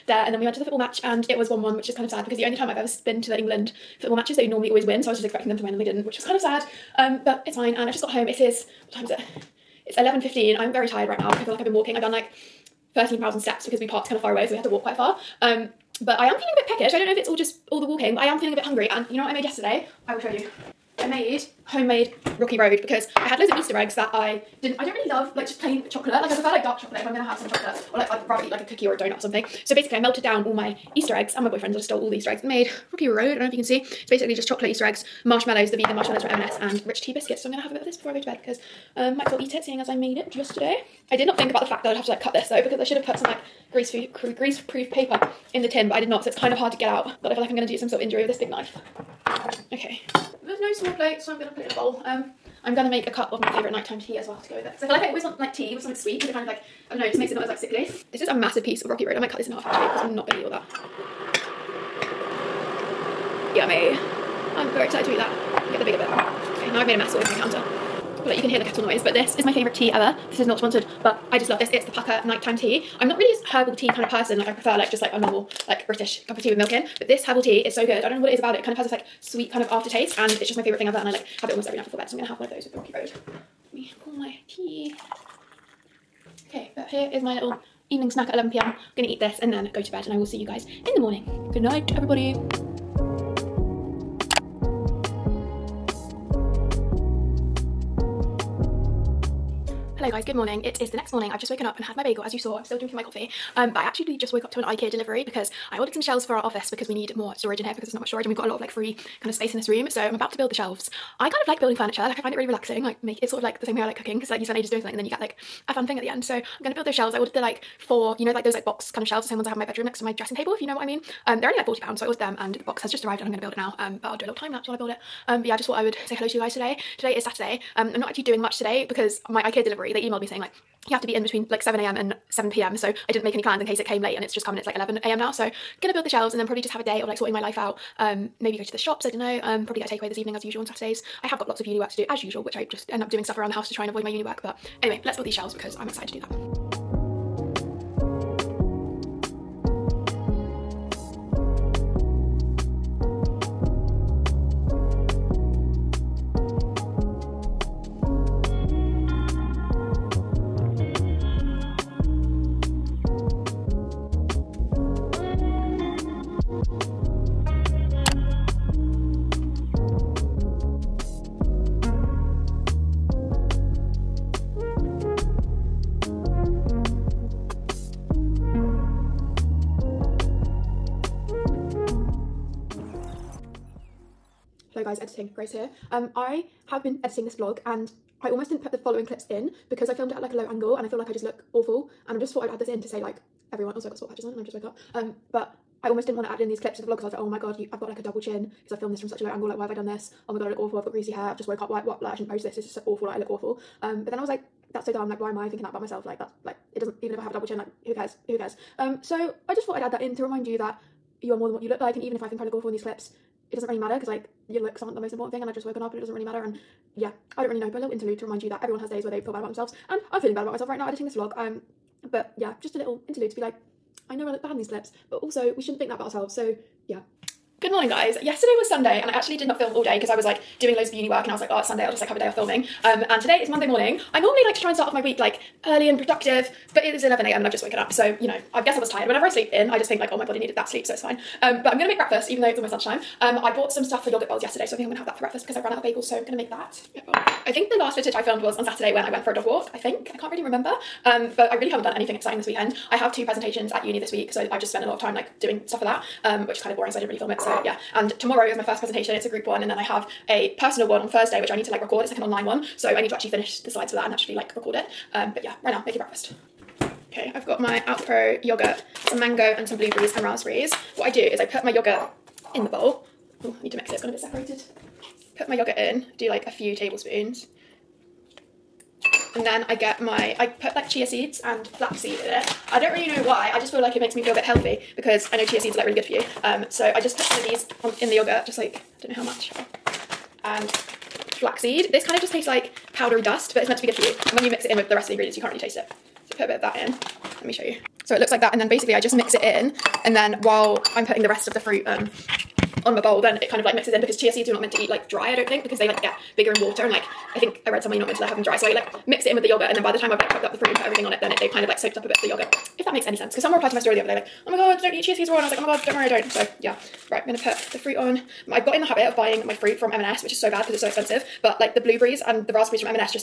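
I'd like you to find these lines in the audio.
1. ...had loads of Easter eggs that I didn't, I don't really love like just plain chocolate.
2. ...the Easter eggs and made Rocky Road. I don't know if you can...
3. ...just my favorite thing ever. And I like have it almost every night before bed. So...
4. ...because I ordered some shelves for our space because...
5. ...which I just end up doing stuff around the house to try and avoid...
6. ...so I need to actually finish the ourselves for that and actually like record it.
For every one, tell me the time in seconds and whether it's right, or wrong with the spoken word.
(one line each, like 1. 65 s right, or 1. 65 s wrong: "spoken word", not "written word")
1. 23 s right
2. 32 s right
3. 80 s right
4. 105 s wrong: "office", not "space"
5. 142 s right
6. 262 s wrong: "slides", not "ourselves".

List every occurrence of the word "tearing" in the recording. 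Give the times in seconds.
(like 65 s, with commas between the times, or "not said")
not said.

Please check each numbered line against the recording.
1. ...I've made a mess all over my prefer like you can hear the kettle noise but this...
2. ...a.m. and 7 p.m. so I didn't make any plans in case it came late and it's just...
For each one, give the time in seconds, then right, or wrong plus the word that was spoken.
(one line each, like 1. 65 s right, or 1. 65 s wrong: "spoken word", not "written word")
1. 66 s wrong: "counter", not "prefer"
2. 131 s right.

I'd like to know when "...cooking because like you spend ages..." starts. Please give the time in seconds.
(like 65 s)
113 s.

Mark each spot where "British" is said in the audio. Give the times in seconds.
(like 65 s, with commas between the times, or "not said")
75 s.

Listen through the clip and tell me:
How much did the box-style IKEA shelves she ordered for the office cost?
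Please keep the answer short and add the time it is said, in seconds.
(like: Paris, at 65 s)
40 pounds, at 121 s.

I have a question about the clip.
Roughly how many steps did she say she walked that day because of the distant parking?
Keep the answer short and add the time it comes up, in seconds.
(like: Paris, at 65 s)
13,000, at 12 s.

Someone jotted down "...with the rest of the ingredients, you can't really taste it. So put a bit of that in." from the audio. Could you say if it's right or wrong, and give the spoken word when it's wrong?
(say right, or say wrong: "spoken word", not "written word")
right.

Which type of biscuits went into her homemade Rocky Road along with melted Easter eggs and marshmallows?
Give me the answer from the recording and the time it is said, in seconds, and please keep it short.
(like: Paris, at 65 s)
Rich tea, at 36 s.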